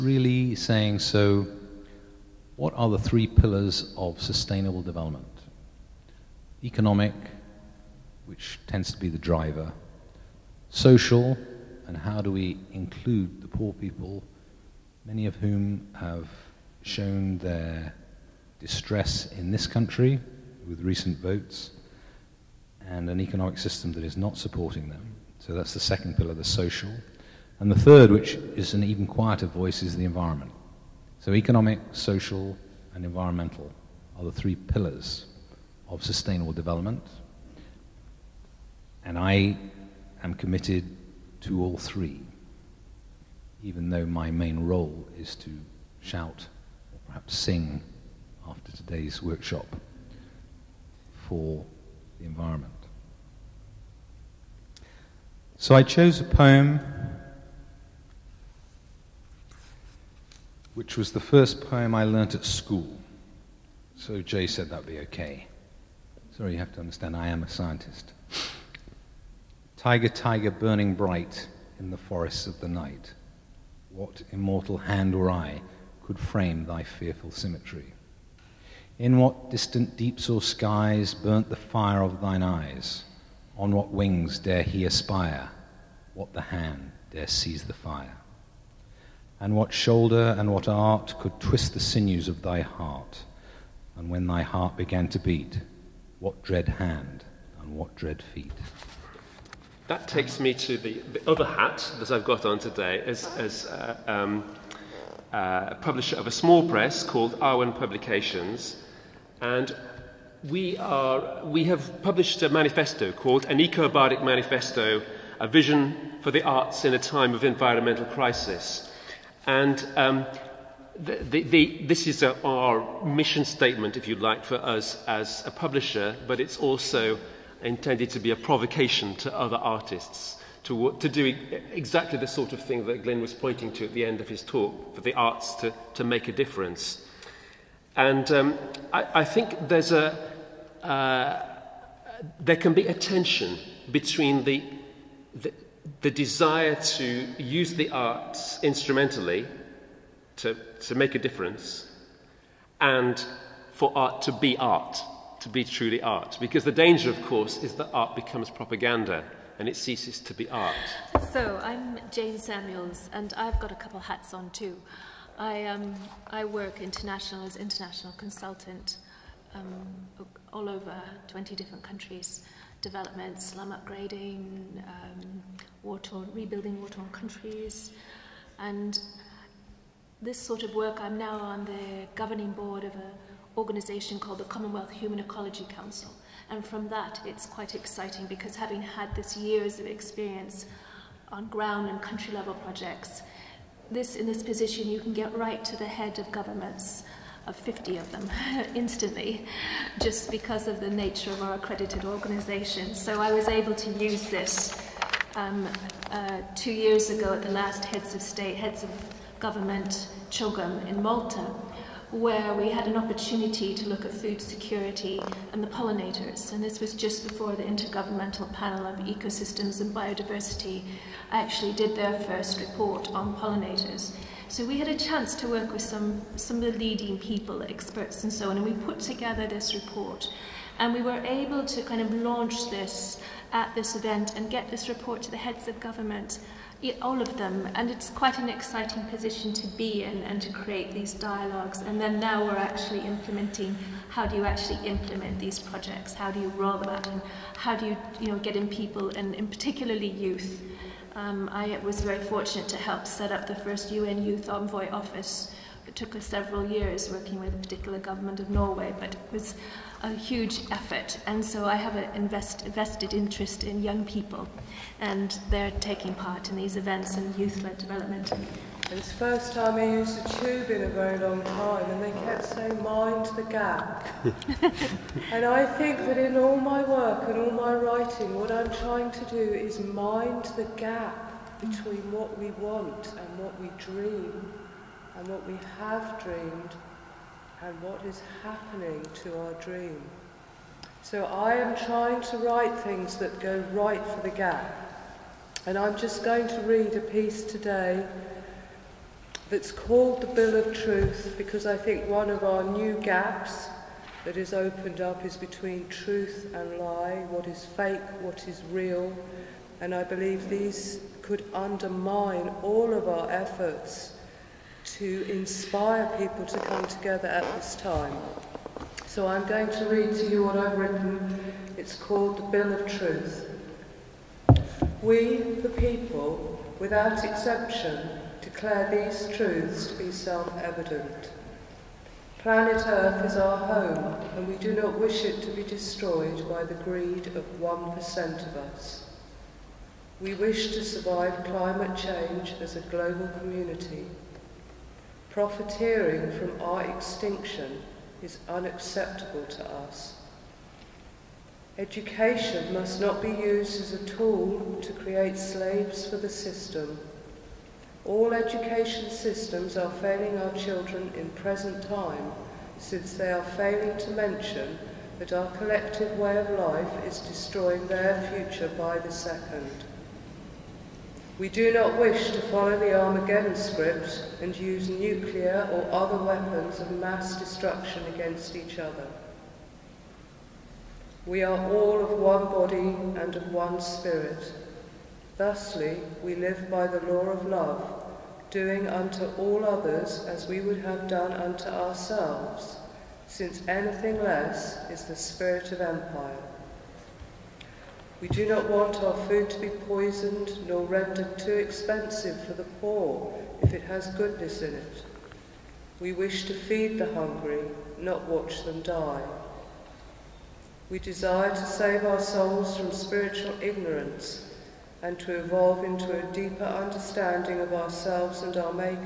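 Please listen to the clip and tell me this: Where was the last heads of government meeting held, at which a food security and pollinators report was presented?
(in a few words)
Malta.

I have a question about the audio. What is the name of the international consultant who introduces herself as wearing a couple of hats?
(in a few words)
Jane Samuels.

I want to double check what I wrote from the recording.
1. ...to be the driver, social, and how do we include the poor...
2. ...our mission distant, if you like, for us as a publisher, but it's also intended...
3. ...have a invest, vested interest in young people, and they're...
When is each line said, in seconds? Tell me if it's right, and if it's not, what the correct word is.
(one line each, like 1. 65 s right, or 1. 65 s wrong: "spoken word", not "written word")
1. 8 s right
2. 122 s wrong: "statement", not "distant"
3. 261 s right.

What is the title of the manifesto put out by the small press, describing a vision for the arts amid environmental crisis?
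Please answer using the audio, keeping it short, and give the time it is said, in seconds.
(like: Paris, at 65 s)
An Eco Bardic Manifesto, at 113 s.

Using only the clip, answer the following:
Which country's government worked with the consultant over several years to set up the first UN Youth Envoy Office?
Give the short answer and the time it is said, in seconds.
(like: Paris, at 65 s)
Norway, at 258 s.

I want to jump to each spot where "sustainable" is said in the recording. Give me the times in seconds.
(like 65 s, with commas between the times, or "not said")
4 s, 36 s.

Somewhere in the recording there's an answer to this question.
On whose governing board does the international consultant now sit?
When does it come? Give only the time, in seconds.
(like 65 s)
184 s.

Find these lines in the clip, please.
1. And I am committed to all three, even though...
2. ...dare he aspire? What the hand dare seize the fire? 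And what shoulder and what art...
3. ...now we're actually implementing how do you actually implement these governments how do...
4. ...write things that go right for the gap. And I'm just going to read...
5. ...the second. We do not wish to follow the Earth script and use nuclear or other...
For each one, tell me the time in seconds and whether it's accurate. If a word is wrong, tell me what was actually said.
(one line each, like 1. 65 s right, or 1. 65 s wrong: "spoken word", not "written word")
1. 39 s right
2. 84 s right
3. 242 s wrong: "projects", not "governments"
4. 292 s right
5. 368 s wrong: "Armageddon", not "Earth".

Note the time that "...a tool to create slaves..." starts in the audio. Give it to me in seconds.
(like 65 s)
353 s.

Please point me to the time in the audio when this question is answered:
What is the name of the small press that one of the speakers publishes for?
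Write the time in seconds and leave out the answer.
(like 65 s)
107 s.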